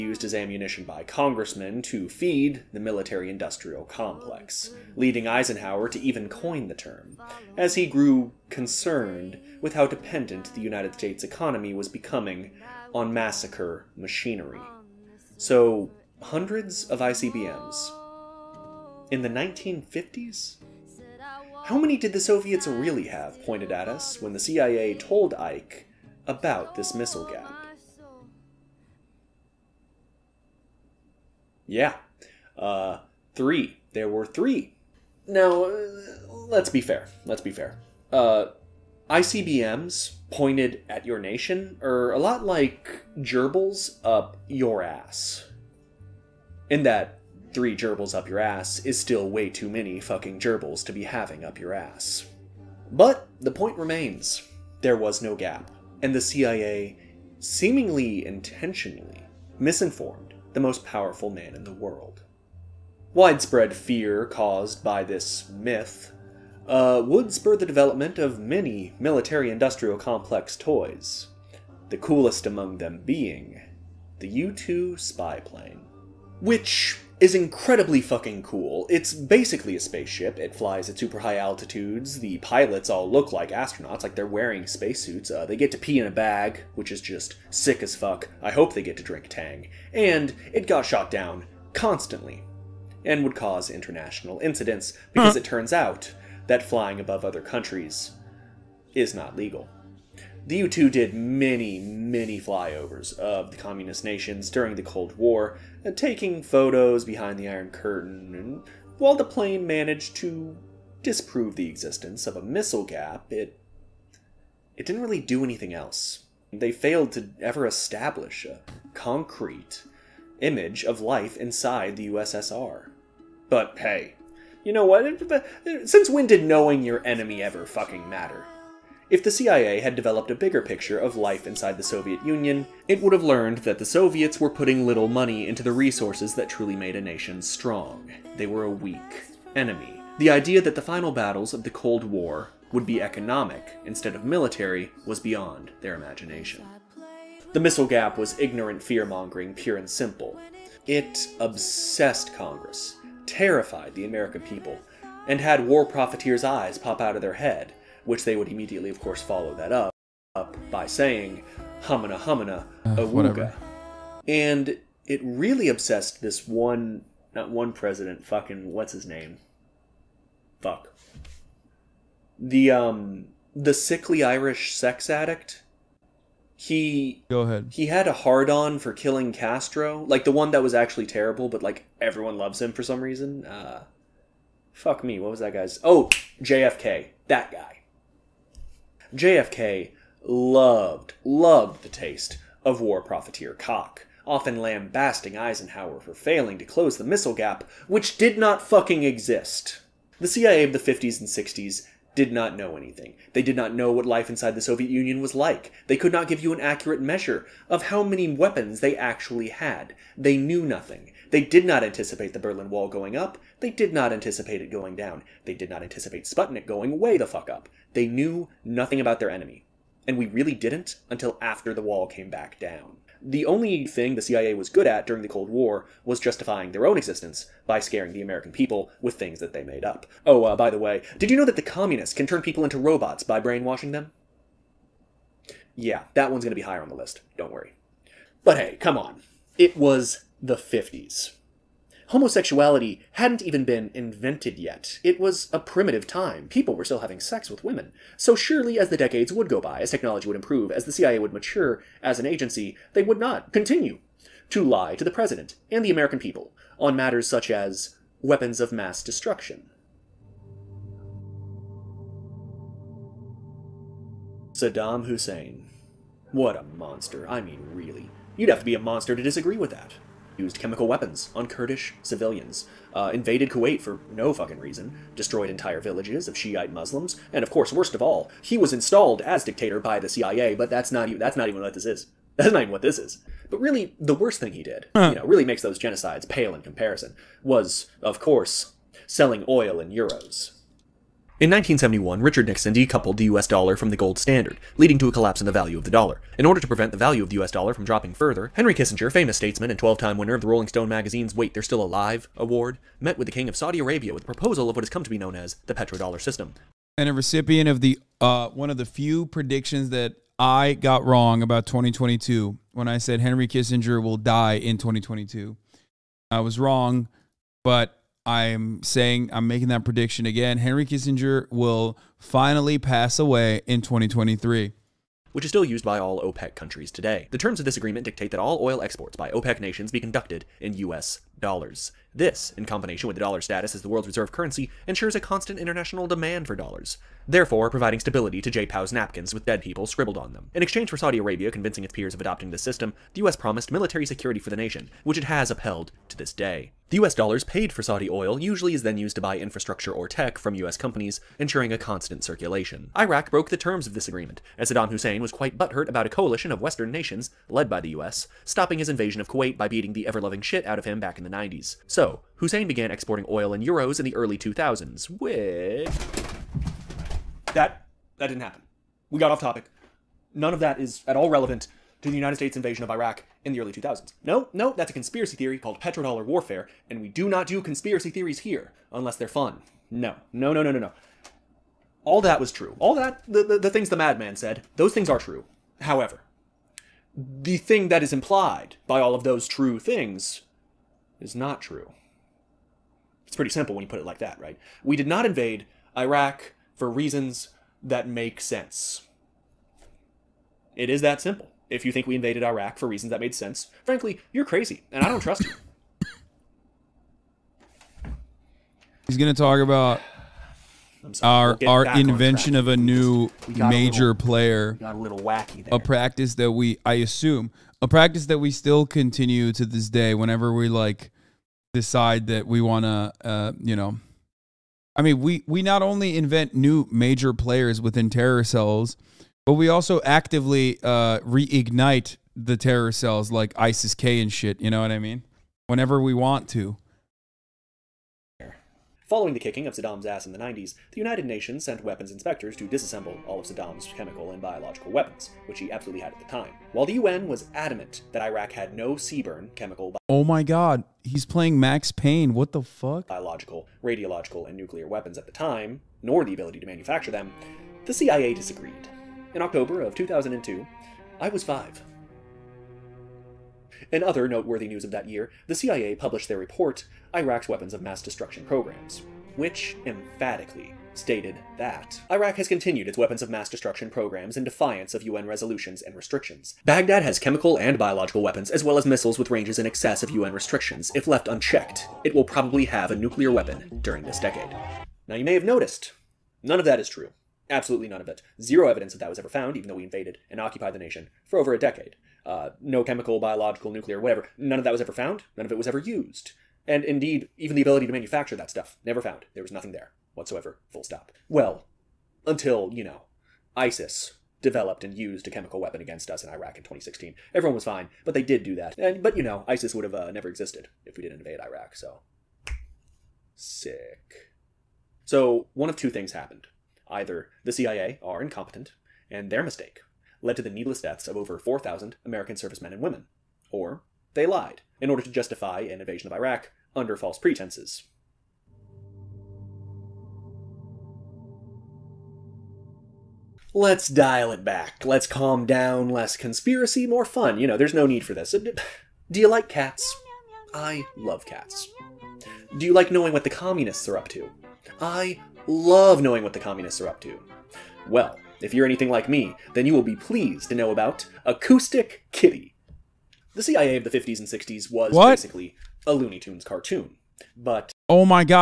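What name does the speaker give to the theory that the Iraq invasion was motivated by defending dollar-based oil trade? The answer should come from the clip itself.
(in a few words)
petrodollar warfare.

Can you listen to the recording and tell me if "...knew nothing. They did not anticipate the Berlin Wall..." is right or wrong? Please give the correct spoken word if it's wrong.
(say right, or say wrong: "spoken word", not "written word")
right.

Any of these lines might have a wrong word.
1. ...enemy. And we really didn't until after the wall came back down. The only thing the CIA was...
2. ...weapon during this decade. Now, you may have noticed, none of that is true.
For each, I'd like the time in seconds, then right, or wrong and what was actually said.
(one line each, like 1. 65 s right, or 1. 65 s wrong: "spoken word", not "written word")
1. 219 s right
2. 483 s right.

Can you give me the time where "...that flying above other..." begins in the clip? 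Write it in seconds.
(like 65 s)
96 s.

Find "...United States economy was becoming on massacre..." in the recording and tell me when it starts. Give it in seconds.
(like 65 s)
10 s.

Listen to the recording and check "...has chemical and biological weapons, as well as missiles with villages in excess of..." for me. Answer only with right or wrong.
wrong.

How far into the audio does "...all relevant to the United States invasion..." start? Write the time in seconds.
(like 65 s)
371 s.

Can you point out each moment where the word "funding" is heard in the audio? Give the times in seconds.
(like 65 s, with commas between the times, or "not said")
not said.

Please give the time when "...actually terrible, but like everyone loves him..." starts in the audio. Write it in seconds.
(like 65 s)
180 s.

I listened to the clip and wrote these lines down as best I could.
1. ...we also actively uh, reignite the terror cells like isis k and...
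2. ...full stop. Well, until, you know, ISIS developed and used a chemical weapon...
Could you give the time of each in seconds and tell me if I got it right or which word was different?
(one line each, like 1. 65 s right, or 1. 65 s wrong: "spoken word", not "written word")
1. 429 s right
2. 500 s right.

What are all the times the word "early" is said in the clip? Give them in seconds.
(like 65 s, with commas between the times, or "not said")
364 s, 373 s.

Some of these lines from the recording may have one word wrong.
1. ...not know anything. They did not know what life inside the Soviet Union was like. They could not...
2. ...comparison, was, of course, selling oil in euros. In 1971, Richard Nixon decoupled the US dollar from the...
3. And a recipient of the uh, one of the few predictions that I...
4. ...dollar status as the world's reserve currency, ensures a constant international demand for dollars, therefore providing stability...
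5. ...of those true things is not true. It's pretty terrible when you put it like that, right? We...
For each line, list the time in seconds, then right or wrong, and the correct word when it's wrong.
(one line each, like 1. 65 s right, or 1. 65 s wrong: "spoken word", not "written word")
1. 202 s right
2. 286 s right
3. 306 s right
4. 333 s right
5. 389 s wrong: "simple", not "terrible".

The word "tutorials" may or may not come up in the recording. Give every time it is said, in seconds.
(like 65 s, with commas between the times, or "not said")
not said.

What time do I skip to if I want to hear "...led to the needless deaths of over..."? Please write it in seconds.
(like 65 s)
520 s.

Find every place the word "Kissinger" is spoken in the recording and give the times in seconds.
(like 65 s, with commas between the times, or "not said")
298 s, 313 s, 320 s.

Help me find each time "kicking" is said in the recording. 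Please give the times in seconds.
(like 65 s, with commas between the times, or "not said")
439 s.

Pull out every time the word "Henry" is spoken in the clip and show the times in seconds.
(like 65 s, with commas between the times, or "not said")
298 s, 313 s, 320 s.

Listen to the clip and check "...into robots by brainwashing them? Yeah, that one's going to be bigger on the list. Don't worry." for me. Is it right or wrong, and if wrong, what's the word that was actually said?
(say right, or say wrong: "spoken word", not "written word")
wrong: "higher", not "bigger".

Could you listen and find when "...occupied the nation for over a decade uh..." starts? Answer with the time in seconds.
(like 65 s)
490 s.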